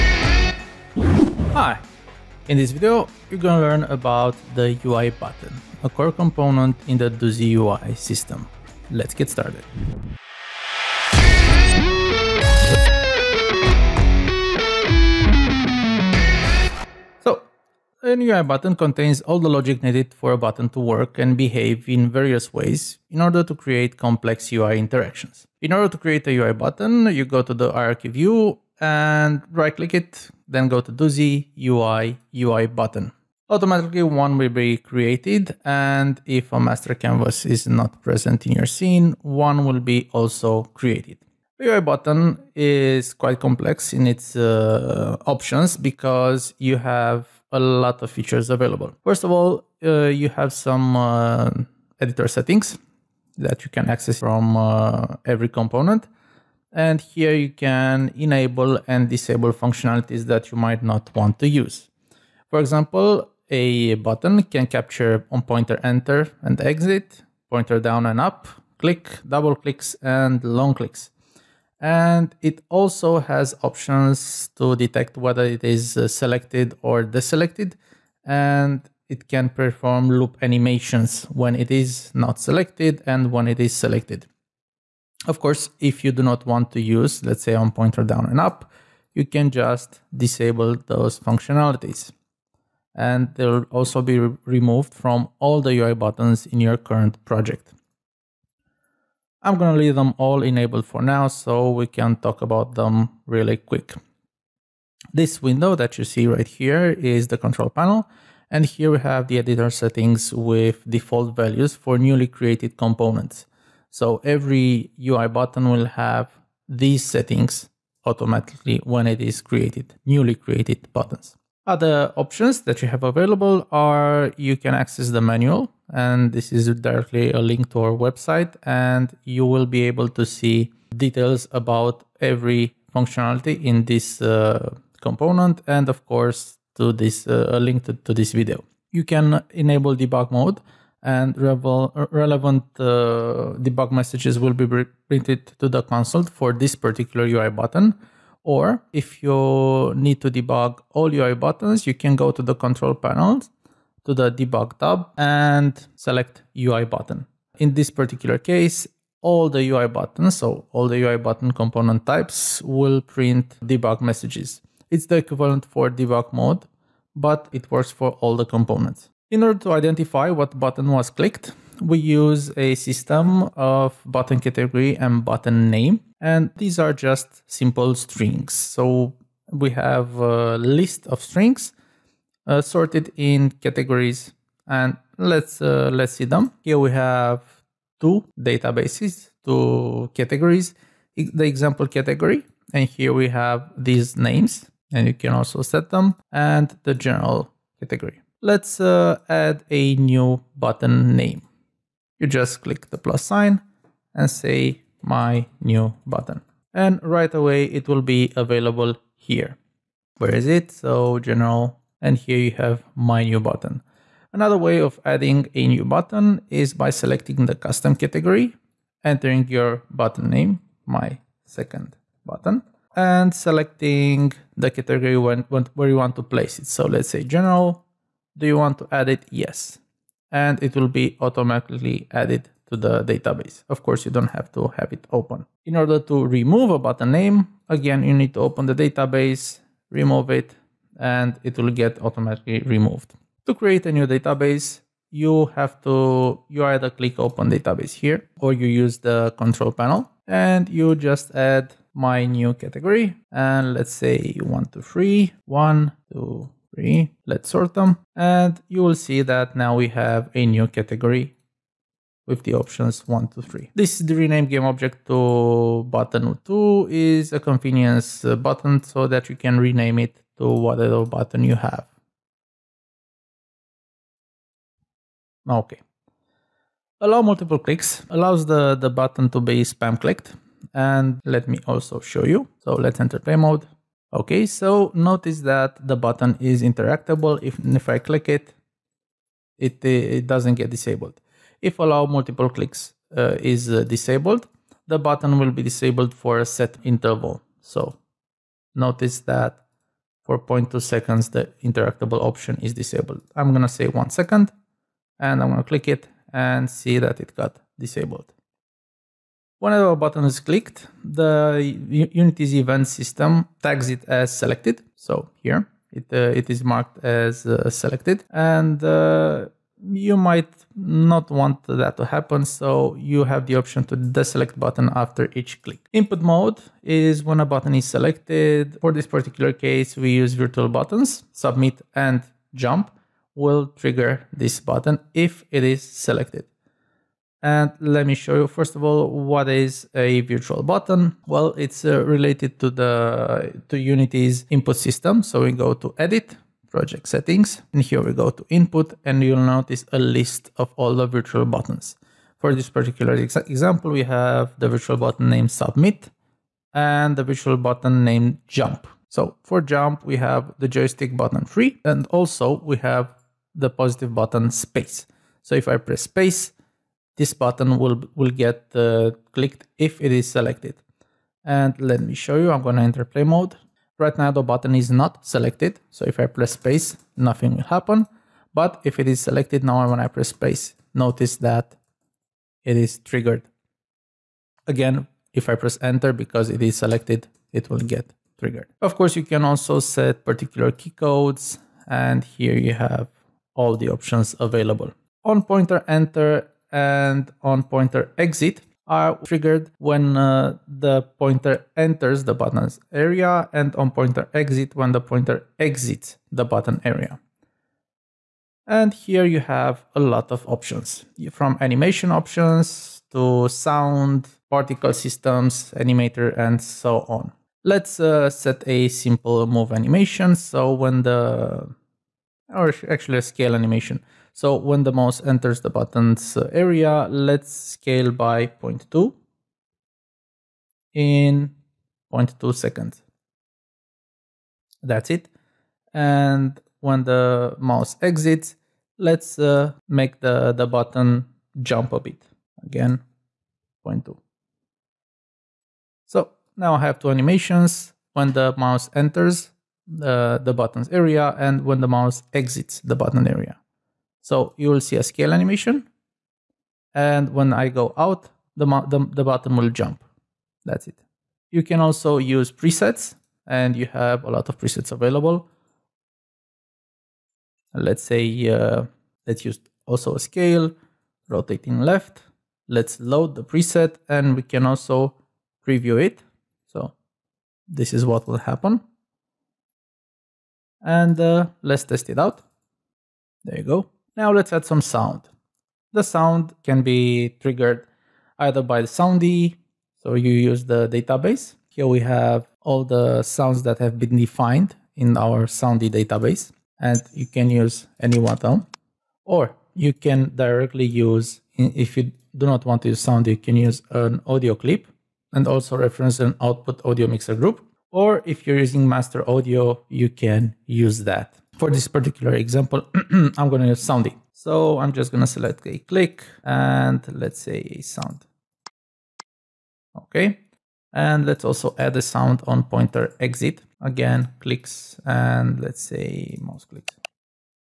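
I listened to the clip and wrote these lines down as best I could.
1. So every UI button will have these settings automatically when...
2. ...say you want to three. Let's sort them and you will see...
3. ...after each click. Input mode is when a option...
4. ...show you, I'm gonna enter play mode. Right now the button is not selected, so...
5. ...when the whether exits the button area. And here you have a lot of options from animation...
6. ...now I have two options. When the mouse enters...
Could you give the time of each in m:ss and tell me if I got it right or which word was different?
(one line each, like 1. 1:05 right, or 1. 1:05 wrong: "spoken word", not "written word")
1. 1:53 right
2. 4:13 right
3. 5:24 wrong: "button", not "option"
4. 6:12 right
5. 6:44 wrong: "pointer", not "whether"
6. 7:26 wrong: "animations", not "options".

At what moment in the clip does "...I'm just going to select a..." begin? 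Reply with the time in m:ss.
8:34.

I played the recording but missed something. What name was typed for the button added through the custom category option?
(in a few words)
My second button.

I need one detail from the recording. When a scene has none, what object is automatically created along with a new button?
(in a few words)
Master canvas.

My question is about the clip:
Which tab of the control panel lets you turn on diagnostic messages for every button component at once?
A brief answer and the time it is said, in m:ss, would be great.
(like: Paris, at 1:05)
Debug tab, at 2:34.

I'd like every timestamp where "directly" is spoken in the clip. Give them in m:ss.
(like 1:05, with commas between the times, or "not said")
2:06, 8:20.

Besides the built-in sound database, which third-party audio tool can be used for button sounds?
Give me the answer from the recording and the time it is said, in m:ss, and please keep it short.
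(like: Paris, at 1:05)
Master Audio, at 8:28.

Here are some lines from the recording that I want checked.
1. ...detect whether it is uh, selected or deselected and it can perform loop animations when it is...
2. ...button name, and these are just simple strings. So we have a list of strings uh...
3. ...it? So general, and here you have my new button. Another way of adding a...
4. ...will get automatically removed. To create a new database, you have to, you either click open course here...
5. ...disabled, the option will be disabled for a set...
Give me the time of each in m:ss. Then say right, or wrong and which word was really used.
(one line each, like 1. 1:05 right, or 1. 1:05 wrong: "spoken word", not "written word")
1. 1:14 right
2. 2:55 right
3. 3:30 right
4. 4:01 wrong: "database", not "course"
5. 4:53 wrong: "button", not "option".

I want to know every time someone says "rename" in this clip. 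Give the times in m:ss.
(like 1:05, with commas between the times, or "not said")
4:24, 4:29.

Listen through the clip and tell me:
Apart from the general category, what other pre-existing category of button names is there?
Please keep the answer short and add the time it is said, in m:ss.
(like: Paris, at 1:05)
Example category, at 3:11.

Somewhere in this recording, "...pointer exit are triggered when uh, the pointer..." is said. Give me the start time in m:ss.
6:37.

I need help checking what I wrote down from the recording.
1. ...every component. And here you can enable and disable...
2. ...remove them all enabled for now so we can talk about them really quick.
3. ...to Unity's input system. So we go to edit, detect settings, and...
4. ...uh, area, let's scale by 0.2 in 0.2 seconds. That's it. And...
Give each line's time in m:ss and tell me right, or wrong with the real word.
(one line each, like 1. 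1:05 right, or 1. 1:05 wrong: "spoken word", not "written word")
1. 0:55 right
2. 1:39 wrong: "leave", not "remove"
3. 5:43 wrong: "project", not "detect"
4. 7:06 right.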